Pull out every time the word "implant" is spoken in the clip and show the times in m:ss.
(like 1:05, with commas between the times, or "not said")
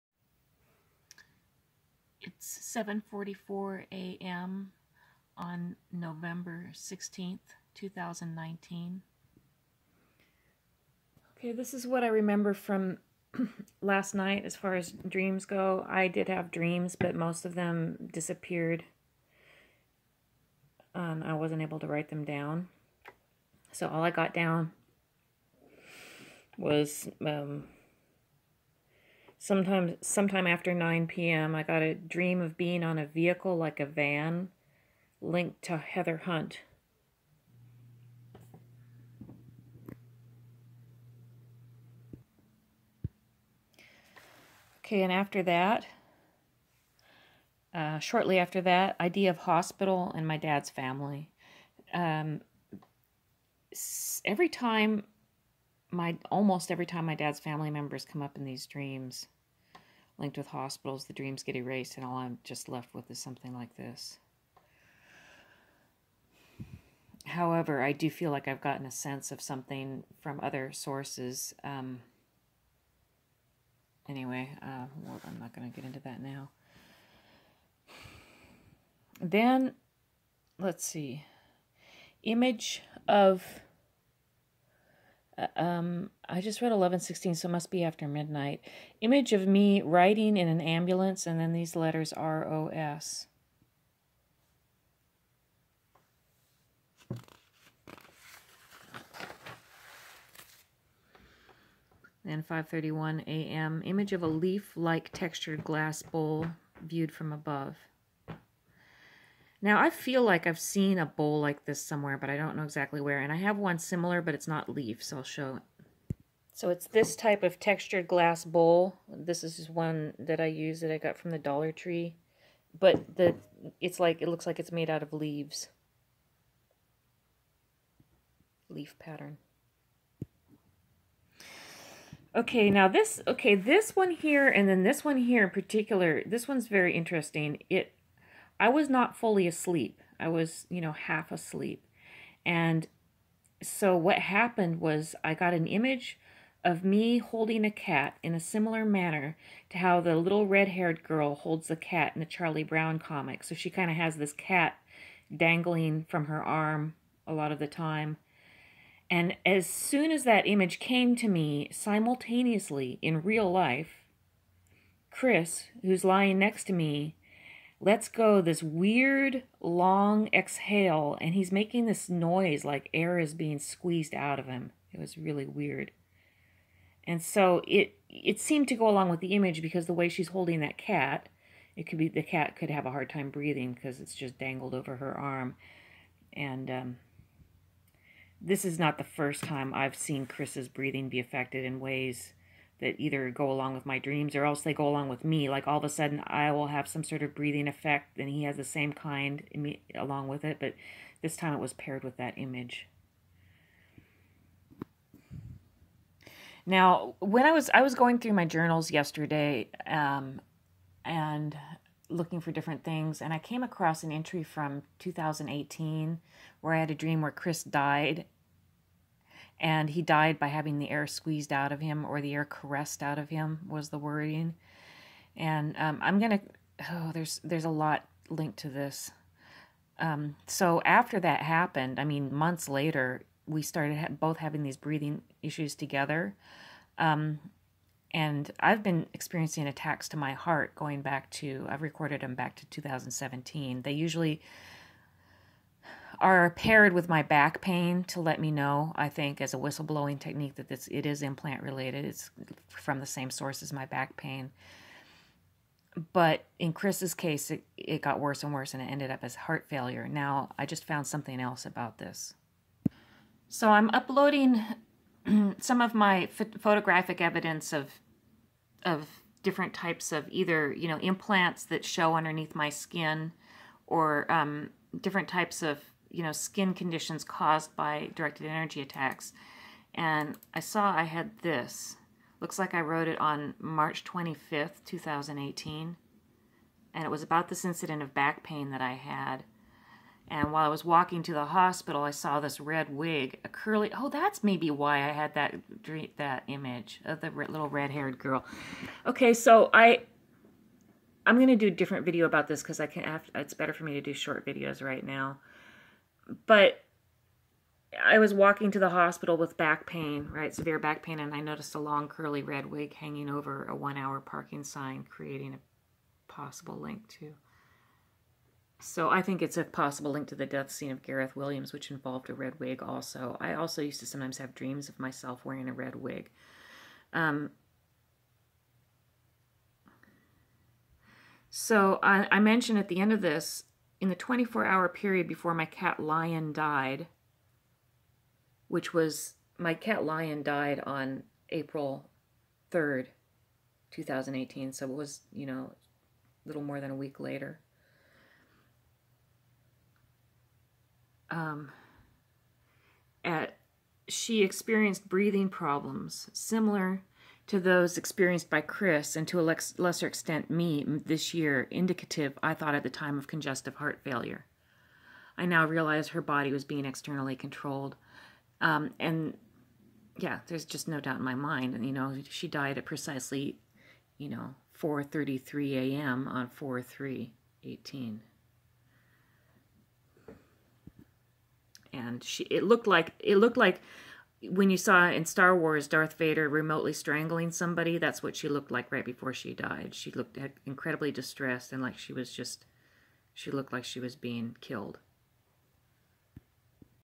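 4:11, 4:30.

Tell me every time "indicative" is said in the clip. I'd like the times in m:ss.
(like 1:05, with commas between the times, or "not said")
6:01.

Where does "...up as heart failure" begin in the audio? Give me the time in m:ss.
4:19.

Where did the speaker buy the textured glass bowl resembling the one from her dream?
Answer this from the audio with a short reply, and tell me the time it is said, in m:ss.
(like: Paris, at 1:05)
Dollar Tree, at 2:01.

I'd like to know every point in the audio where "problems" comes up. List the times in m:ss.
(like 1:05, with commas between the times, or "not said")
5:55.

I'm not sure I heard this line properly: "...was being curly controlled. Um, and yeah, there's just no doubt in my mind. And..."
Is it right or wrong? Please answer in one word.
wrong.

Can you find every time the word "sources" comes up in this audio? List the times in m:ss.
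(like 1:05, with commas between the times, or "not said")
1:10, 4:13.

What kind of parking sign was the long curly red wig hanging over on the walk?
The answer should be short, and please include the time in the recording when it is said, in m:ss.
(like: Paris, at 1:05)
One hour parking sign, at 5:13.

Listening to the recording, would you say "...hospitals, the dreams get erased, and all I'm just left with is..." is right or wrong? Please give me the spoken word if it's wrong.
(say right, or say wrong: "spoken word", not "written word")
right.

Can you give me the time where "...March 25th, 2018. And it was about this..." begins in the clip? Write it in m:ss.
4:43.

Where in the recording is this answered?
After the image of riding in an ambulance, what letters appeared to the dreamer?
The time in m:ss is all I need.
1:32.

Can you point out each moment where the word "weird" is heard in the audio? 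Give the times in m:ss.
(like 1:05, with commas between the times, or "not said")
2:48, 2:55.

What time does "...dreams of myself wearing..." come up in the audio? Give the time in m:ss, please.
5:24.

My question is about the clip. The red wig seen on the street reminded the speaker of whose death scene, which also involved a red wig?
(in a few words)
Gareth Williams.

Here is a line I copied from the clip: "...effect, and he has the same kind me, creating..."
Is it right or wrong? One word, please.
wrong.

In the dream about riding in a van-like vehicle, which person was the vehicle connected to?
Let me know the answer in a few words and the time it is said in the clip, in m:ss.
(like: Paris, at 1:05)
Heather Hundt, at 0:35.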